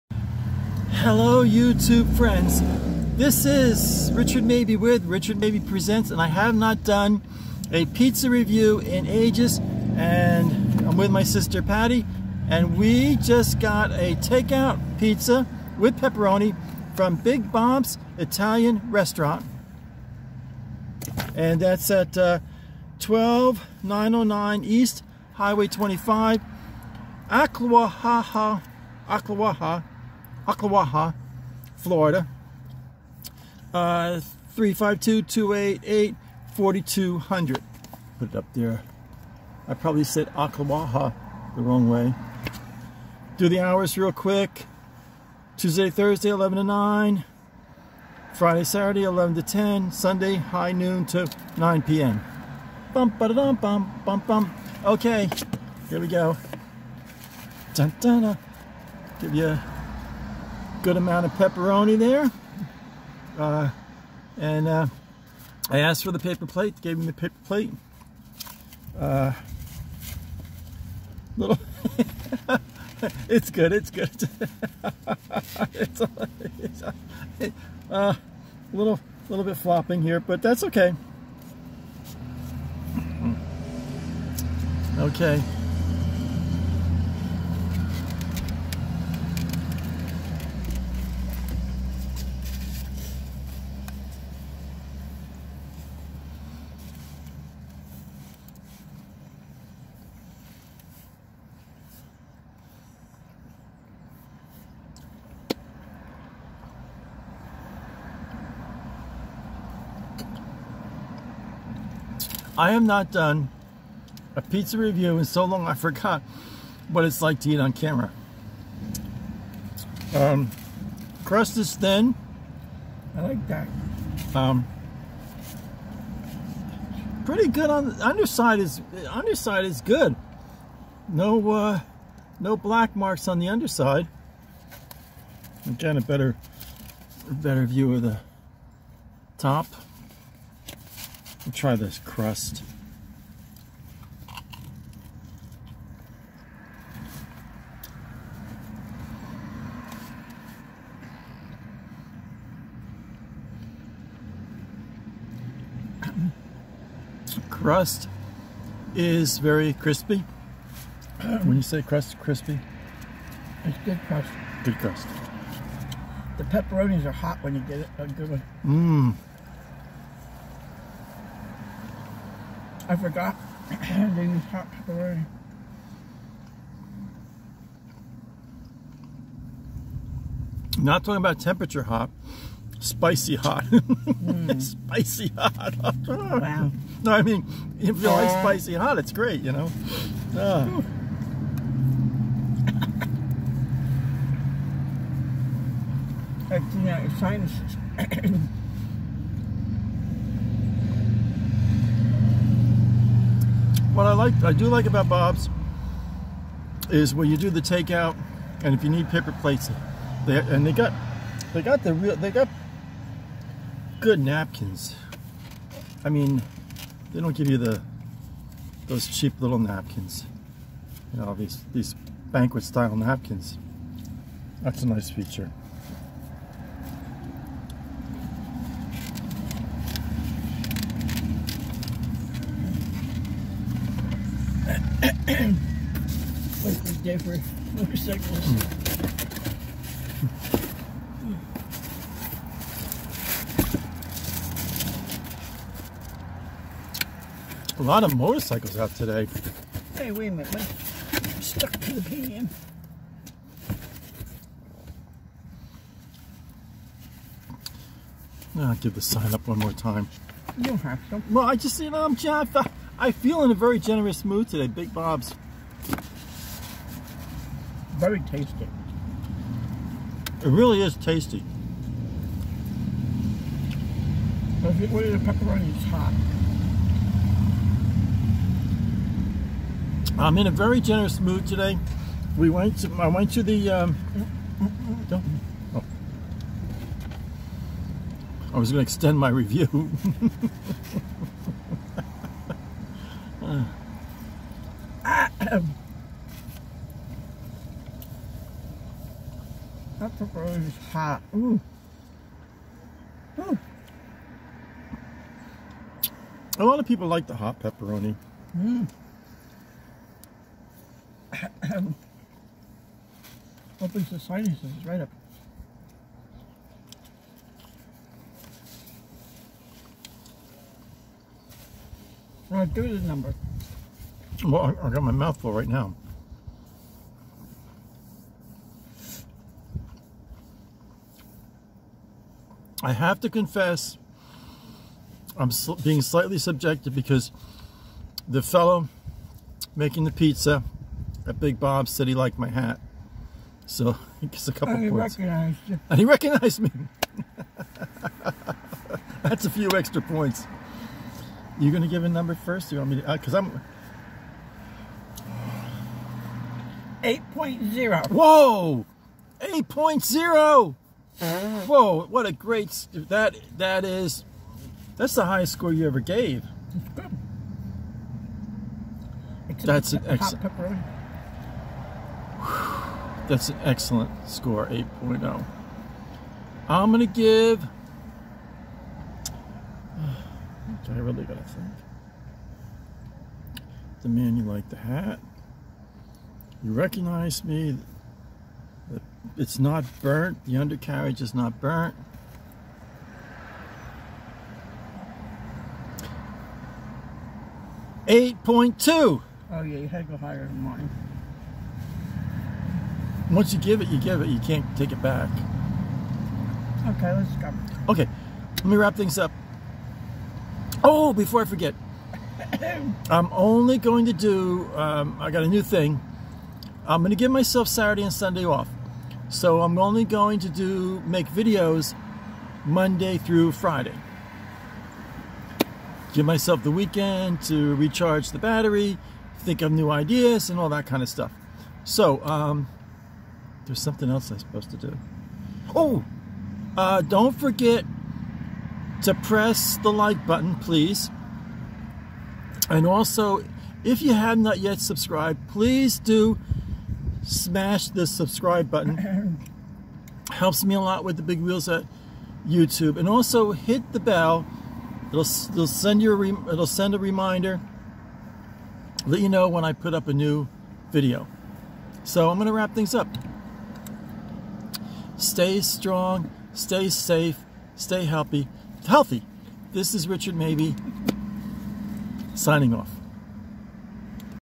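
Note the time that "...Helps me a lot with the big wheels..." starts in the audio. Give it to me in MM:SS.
07:30.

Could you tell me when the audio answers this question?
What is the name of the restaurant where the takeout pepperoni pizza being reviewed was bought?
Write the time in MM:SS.
00:17.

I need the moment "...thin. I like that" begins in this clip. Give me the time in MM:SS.
02:01.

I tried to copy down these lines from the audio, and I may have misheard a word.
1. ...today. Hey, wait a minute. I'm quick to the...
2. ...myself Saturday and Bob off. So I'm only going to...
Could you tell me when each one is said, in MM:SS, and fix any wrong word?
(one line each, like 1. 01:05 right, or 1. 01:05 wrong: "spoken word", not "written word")
1. 04:08 wrong: "stuck", not "quick"
2. 06:57 wrong: "Sunday", not "Bob".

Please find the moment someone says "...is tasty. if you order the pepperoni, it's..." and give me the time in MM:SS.
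04:30.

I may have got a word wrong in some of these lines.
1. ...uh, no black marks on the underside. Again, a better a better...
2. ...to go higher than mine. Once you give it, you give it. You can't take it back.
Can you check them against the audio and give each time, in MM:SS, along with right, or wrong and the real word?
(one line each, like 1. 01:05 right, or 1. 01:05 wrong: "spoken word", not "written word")
1. 02:11 right
2. 06:40 right.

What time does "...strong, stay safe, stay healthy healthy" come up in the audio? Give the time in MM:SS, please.
07:45.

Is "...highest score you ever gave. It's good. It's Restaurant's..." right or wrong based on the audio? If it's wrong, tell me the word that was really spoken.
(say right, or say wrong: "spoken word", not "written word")
wrong: "That", not "Restaurant".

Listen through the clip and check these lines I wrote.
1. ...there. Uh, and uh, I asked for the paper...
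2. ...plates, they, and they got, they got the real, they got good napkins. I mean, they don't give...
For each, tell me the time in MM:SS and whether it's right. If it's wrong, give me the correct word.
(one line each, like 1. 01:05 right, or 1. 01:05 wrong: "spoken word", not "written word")
1. 01:01 right
2. 03:29 right.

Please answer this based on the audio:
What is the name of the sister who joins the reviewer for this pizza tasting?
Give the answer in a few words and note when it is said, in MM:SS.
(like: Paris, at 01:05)
Patty, at 00:11.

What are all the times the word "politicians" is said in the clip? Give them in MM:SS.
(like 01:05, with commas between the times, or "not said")
not said.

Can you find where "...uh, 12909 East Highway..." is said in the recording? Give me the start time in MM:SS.
00:22.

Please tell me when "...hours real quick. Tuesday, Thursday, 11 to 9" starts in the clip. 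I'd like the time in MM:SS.
00:43.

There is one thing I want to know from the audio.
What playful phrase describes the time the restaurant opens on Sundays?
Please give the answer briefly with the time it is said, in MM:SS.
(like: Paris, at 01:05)
high noon, at 00:50.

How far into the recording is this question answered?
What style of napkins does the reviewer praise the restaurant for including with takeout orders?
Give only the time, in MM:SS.
03:42.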